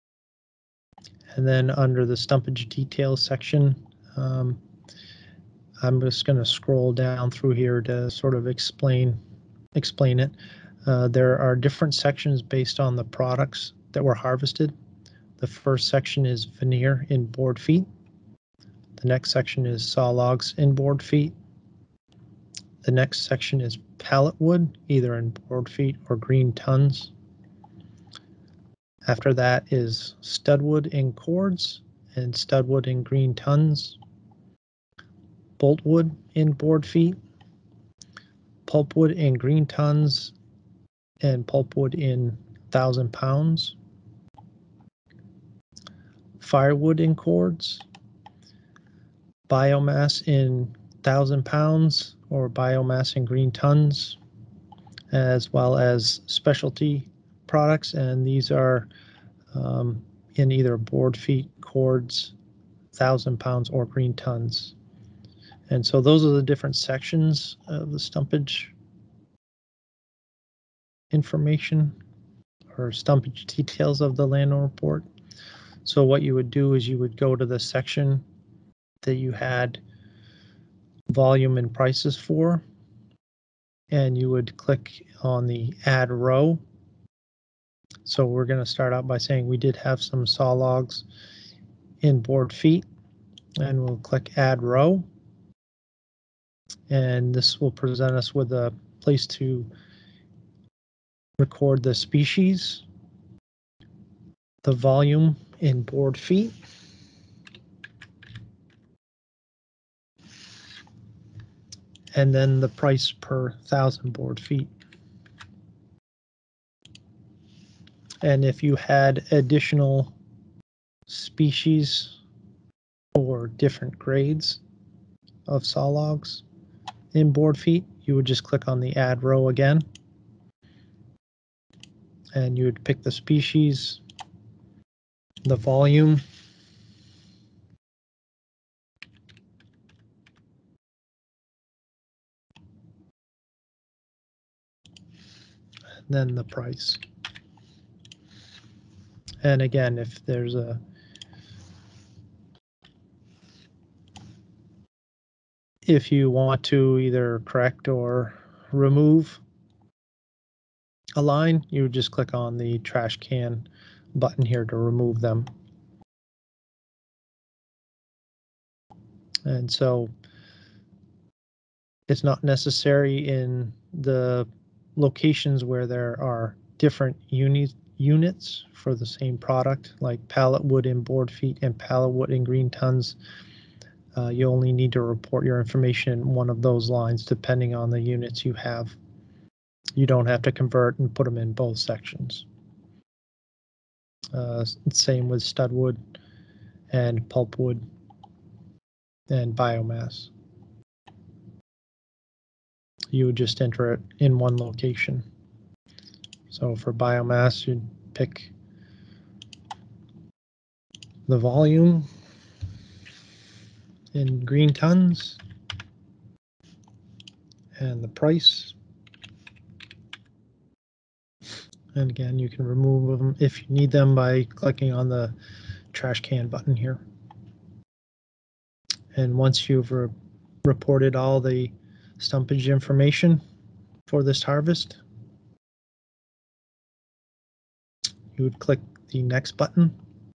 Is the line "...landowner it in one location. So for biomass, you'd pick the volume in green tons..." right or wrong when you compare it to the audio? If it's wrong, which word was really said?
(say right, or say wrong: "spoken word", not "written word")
wrong: "enter", not "landowner".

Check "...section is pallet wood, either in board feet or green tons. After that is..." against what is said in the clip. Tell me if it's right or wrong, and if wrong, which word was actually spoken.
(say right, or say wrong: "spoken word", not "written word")
right.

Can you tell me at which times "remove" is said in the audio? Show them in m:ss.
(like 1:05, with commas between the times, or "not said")
2:38, 2:44, 3:42.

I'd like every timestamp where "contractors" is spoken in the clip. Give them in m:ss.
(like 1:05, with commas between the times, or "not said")
not said.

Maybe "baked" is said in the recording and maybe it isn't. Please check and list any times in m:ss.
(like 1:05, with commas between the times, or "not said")
not said.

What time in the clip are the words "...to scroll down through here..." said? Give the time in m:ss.
0:06.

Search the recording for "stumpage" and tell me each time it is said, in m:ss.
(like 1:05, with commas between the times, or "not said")
0:02, 1:07, 1:12, 3:52.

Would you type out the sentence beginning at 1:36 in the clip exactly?
And this will present us with a place to record the species, the volume in board feet.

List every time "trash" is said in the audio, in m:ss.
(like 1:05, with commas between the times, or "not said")
2:42, 3:45.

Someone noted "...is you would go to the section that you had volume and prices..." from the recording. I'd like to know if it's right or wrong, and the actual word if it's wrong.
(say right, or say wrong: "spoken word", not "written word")
right.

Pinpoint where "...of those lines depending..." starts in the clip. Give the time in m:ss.
3:06.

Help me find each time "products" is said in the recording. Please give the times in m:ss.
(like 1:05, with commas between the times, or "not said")
0:13, 0:57, 2:59.